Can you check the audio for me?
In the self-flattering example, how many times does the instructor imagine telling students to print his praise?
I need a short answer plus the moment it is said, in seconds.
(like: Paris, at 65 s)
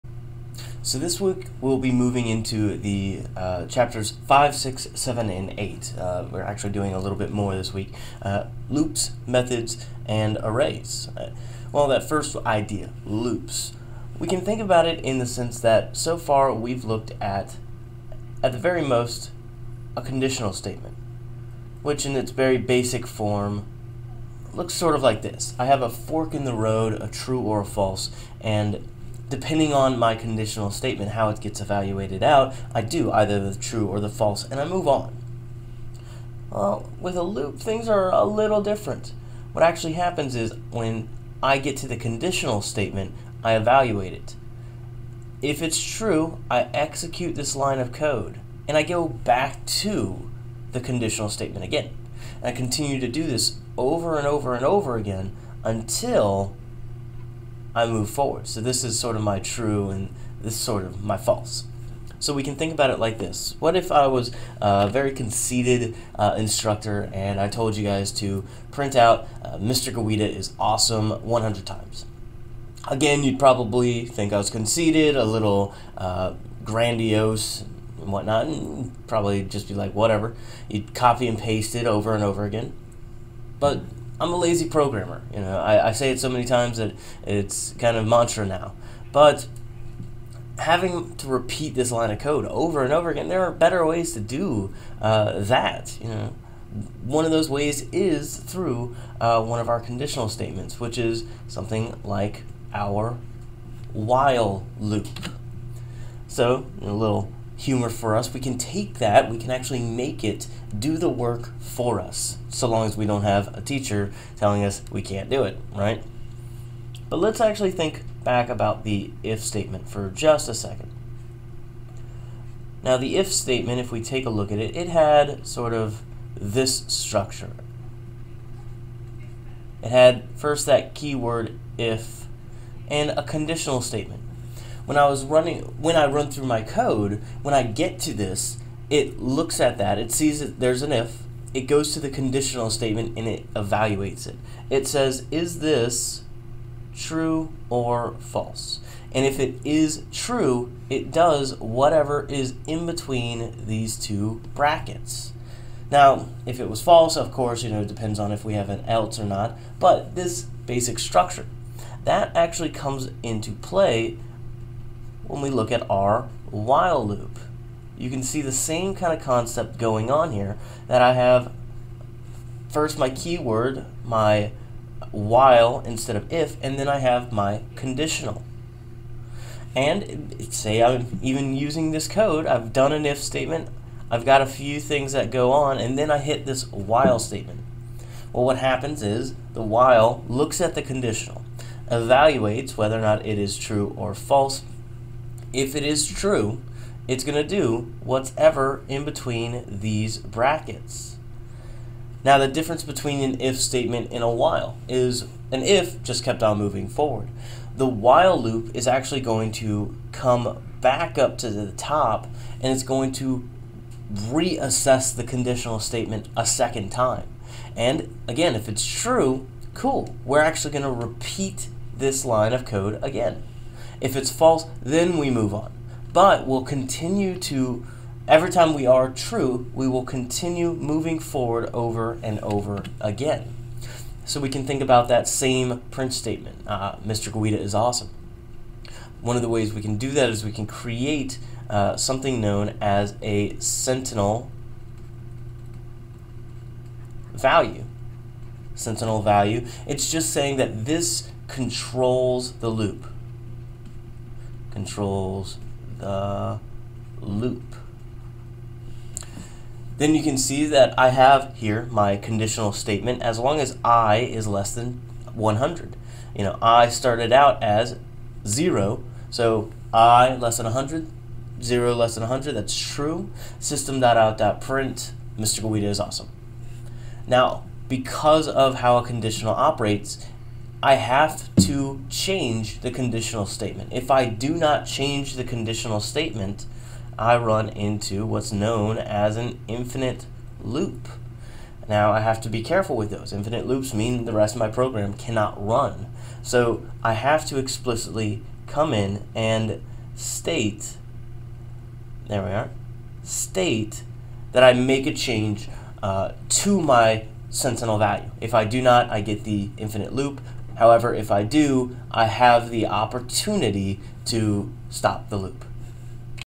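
100, at 71 s.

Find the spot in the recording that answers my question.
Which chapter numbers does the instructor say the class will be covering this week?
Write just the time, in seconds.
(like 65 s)
3 s.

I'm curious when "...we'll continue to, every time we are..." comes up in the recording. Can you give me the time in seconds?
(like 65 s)
226 s.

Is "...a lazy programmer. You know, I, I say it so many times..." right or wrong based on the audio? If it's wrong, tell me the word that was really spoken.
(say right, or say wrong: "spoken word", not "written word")
right.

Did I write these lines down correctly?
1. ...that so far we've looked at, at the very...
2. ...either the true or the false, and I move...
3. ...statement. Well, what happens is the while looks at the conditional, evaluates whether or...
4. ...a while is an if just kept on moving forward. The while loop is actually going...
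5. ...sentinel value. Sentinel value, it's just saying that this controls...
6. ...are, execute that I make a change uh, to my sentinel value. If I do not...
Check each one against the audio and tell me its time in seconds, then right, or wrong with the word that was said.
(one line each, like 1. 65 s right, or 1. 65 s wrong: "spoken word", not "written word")
1. 15 s right
2. 33 s right
3. 187 s right
4. 204 s right
5. 243 s right
6. 302 s wrong: "state", not "execute".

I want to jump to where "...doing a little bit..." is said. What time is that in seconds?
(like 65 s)
6 s.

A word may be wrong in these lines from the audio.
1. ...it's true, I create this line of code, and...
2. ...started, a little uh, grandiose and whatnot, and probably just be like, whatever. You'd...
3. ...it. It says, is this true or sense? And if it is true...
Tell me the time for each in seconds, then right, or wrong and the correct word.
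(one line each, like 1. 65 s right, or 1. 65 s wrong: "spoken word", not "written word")
1. 45 s wrong: "execute", not "create"
2. 74 s wrong: "conceited", not "started"
3. 144 s wrong: "false", not "sense".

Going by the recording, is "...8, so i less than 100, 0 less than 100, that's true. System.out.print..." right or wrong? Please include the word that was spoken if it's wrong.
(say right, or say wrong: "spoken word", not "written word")
wrong: "0", not "8".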